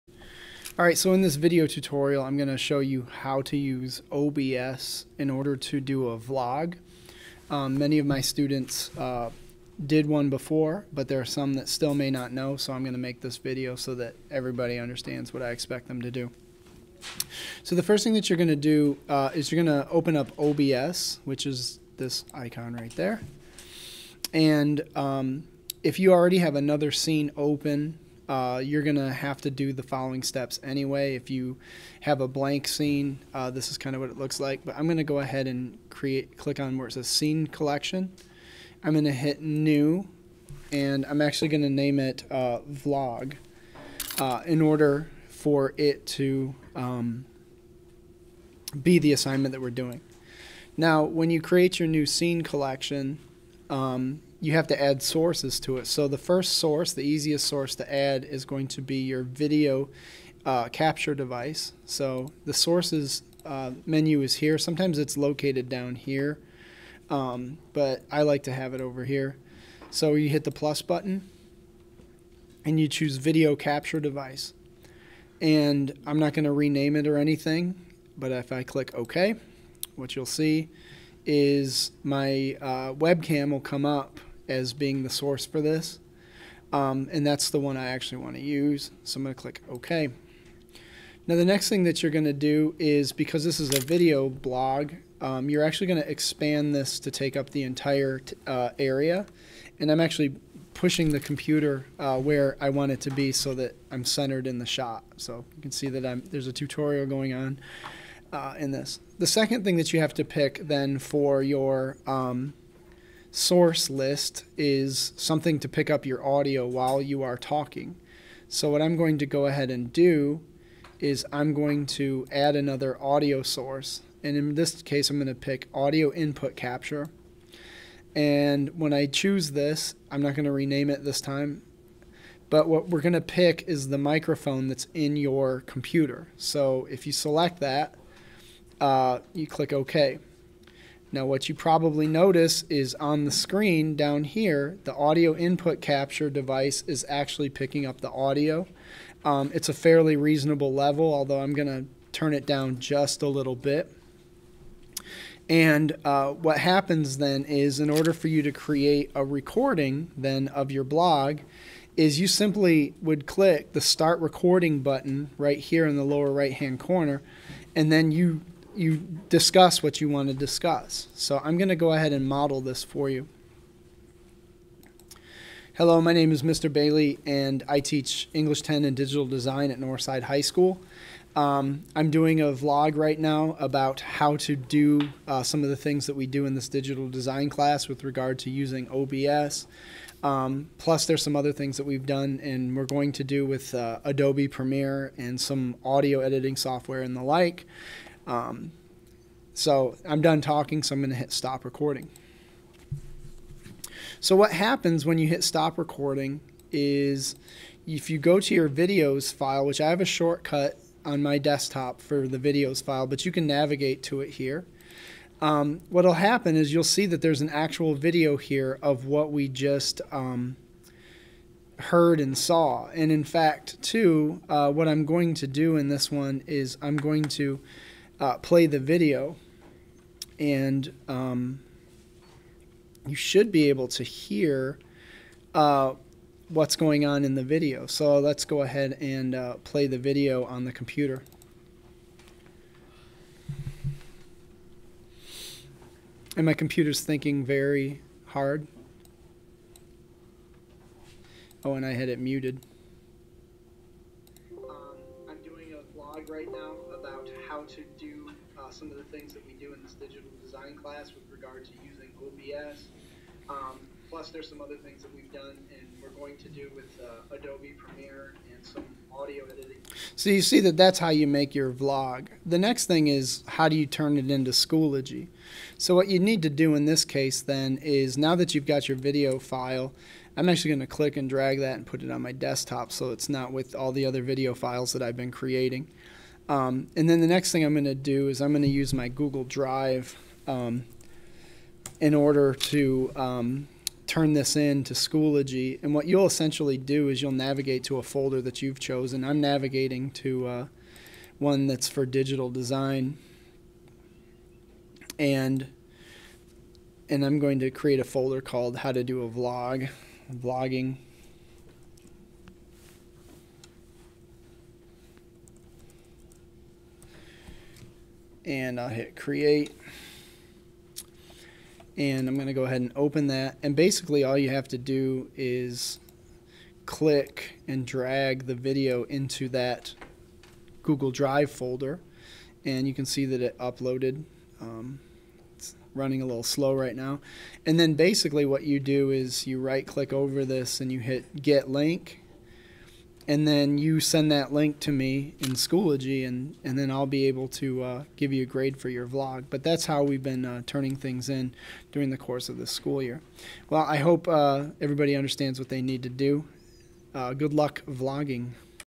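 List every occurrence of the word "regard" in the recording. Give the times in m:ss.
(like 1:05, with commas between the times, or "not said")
3:08, 4:21.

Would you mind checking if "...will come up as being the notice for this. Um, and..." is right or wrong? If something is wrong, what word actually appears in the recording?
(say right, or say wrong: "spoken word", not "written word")
wrong: "source", not "notice".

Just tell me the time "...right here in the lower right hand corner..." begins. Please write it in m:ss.
2:45.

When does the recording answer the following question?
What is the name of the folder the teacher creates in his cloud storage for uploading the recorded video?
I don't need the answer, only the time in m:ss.
5:08.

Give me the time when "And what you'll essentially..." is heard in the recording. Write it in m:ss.
4:55.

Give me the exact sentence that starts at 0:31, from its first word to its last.
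If you have a blank scene, uh, this is kind of what it looks like.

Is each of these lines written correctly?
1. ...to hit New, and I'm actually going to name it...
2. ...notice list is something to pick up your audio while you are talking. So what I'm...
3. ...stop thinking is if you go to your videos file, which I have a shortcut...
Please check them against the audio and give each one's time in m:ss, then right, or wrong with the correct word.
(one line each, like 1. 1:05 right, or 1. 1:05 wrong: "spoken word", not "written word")
1. 0:39 right
2. 1:53 wrong: "source", not "notice"
3. 3:25 wrong: "recording", not "thinking".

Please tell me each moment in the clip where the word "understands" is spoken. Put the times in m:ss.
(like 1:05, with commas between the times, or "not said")
0:14, 5:55.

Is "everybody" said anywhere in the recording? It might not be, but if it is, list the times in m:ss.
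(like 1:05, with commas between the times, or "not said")
0:14, 5:54.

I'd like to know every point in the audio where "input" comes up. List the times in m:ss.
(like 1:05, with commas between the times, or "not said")
2:06, 2:25.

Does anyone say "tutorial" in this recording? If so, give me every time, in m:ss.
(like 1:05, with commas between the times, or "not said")
0:01, 1:46.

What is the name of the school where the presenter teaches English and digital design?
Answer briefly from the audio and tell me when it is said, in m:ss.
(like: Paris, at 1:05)
Northside High School, at 2:59.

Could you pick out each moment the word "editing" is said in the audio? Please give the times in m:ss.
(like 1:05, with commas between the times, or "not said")
3:16, 4:29.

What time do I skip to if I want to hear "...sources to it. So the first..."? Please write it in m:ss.
0:55.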